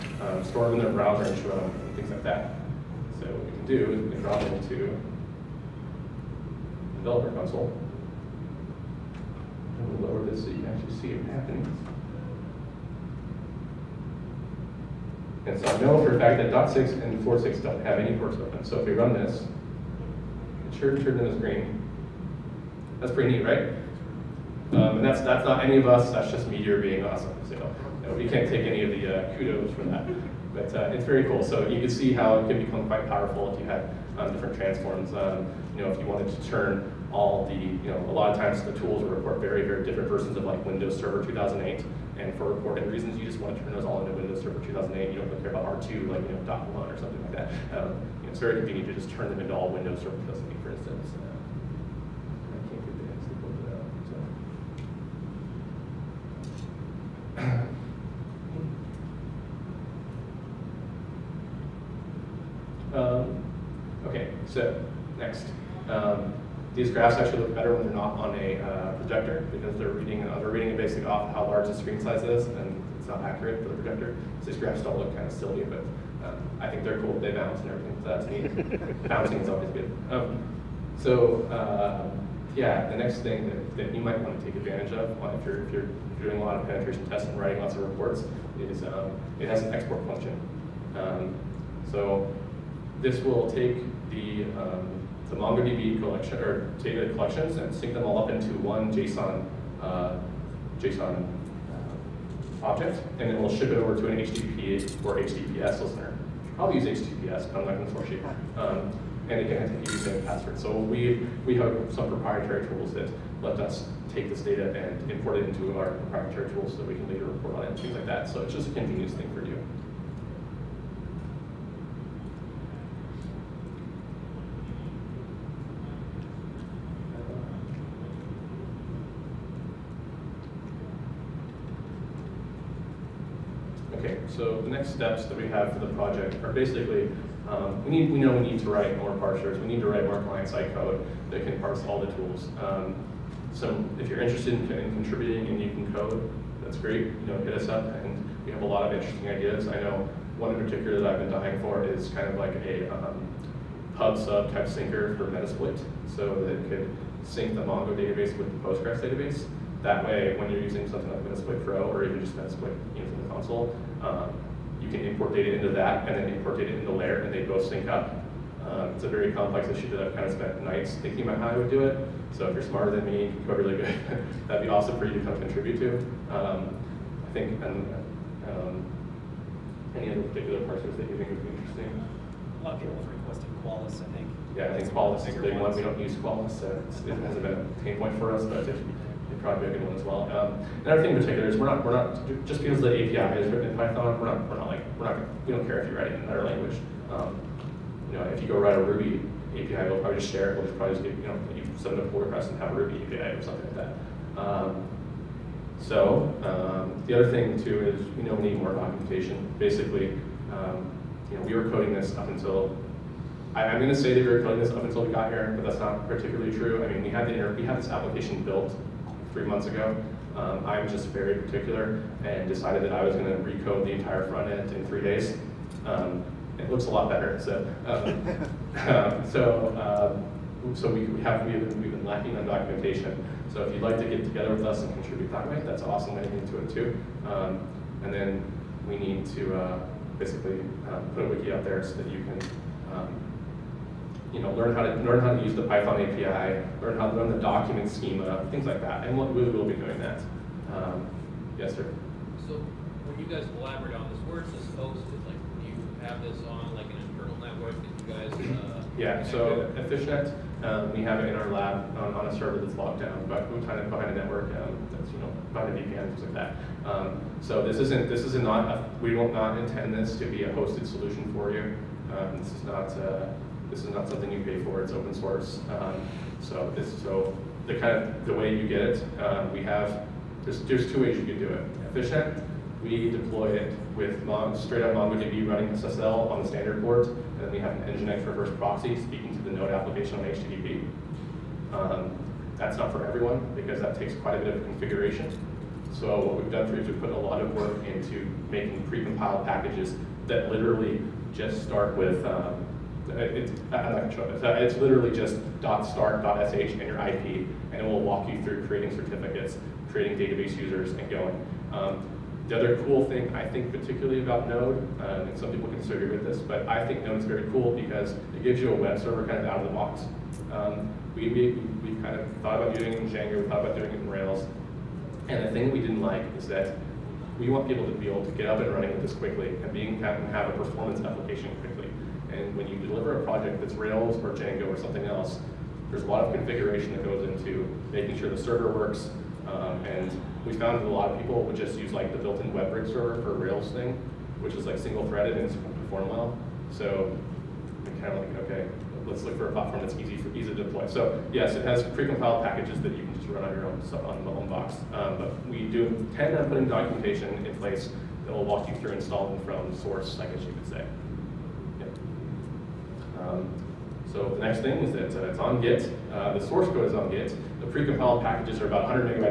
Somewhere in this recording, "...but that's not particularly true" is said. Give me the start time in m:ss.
3:35.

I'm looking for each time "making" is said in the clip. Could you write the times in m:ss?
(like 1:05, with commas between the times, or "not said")
4:58, 5:37.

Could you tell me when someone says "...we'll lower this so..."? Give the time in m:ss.
0:09.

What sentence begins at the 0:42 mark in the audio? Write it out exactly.
And for reporting reasons, you just want to turn those all into Windows Server 2008.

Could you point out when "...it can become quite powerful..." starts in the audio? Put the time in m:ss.
0:32.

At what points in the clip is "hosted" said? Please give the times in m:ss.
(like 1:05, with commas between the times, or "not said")
4:14, 4:30.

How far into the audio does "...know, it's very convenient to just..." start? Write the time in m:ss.
0:48.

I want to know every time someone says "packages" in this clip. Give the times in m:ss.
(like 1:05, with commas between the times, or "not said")
4:59, 5:52, 6:08.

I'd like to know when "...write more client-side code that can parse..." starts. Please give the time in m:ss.
2:19.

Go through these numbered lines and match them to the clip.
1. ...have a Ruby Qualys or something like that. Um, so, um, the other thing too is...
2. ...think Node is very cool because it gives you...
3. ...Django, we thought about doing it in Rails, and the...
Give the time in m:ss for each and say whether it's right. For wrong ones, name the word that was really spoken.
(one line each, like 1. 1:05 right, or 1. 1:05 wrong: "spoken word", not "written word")
1. 3:22 wrong: "API", not "Qualys"
2. 5:16 right
3. 5:23 right.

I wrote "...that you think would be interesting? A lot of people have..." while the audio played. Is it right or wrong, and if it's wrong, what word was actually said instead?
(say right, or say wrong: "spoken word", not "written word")
right.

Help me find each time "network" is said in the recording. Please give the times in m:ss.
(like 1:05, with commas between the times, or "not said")
4:17, 4:24.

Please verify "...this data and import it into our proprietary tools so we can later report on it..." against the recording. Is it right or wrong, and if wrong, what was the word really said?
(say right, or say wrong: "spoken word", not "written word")
right.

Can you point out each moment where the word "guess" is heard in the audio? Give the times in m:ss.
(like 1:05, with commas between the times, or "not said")
6:00.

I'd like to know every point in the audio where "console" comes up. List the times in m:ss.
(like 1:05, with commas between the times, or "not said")
0:07, 2:43.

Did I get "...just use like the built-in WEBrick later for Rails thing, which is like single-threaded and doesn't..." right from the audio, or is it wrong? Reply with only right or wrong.
wrong.